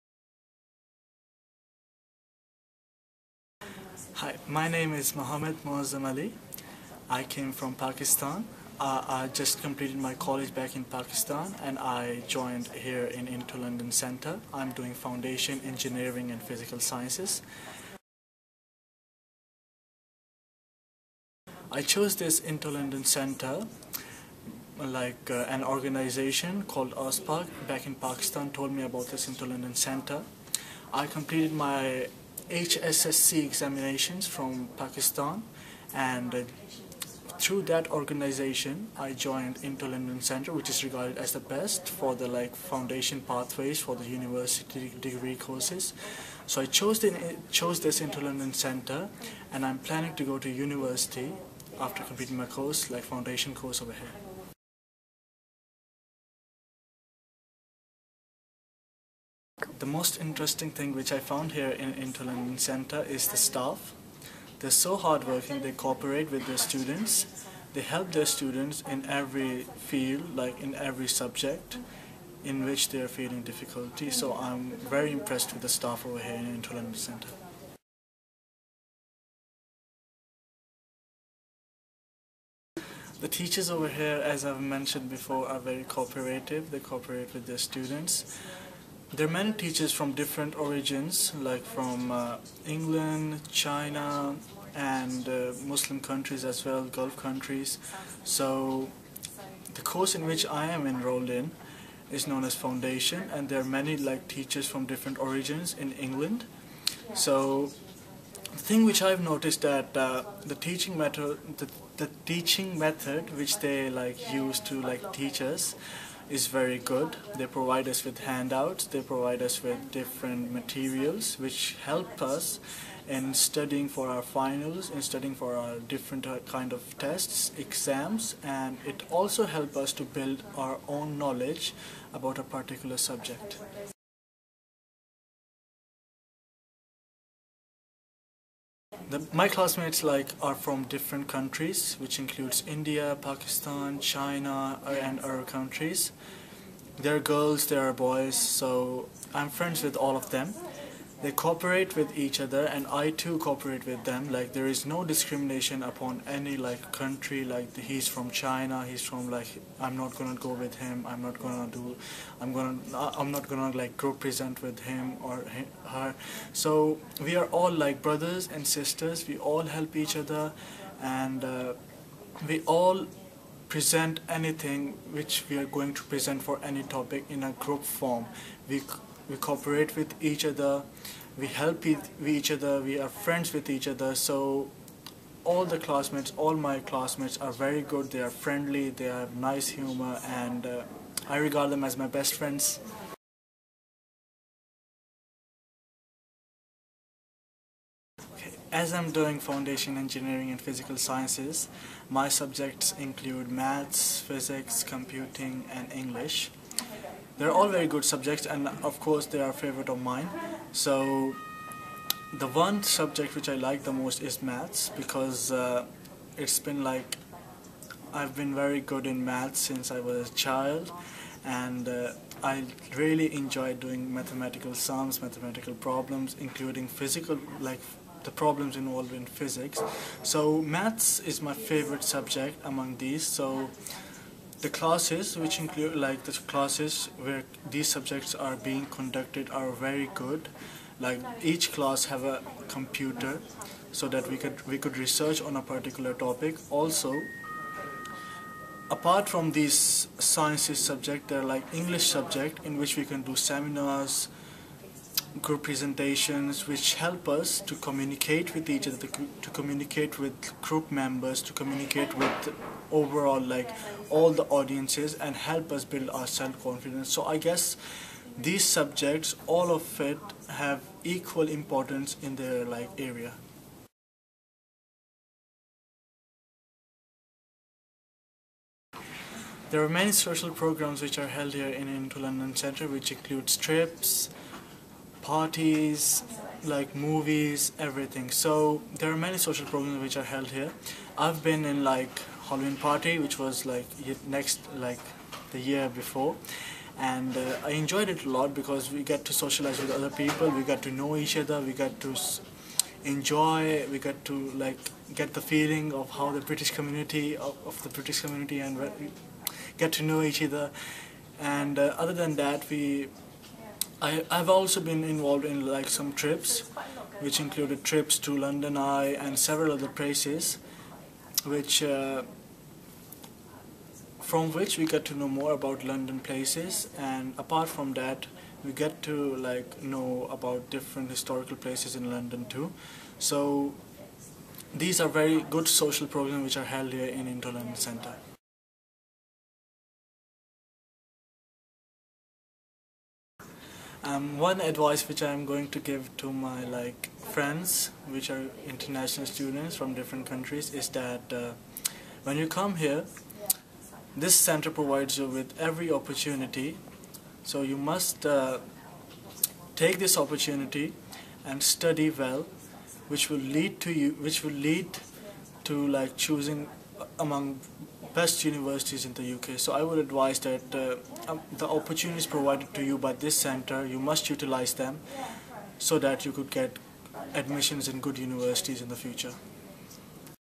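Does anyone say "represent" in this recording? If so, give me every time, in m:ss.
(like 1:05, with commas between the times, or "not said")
2:44.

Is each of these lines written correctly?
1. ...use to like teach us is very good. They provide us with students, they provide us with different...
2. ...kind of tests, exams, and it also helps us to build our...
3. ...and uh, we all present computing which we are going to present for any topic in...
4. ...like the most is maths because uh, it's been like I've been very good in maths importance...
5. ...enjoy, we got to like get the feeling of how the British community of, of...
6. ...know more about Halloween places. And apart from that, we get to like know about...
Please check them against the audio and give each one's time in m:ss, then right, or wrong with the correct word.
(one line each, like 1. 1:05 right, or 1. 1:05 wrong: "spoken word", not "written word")
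1. 1:54 wrong: "handouts", not "students"
2. 2:06 right
3. 2:51 wrong: "anything", not "computing"
4. 3:33 wrong: "since", not "importance"
5. 5:03 right
6. 5:25 wrong: "London", not "Halloween".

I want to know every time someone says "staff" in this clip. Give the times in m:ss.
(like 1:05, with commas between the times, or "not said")
1:03, 1:15.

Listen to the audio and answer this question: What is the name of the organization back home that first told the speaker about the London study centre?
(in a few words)
OSPAC.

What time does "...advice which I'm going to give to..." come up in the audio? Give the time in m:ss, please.
5:44.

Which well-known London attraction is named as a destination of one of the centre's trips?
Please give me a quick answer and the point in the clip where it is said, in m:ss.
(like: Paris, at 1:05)
London Eye, at 5:18.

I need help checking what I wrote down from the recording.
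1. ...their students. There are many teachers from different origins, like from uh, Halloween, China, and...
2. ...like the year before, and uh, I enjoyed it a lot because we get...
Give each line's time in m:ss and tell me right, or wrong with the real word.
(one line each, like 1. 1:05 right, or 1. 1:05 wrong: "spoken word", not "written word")
1. 1:27 wrong: "England", not "Halloween"
2. 4:54 right.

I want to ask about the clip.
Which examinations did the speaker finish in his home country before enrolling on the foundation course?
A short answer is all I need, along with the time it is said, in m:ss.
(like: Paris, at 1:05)
HSSC, at 0:32.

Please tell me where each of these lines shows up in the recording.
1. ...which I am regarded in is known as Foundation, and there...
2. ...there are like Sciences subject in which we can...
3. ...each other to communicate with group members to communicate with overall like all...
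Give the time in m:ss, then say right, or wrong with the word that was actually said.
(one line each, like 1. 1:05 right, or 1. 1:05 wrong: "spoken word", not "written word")
1. 1:40 wrong: "enrolled", not "regarded"
2. 4:11 wrong: "English", not "Sciences"
3. 4:18 right.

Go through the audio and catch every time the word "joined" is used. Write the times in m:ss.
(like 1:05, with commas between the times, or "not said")
0:12, 0:39.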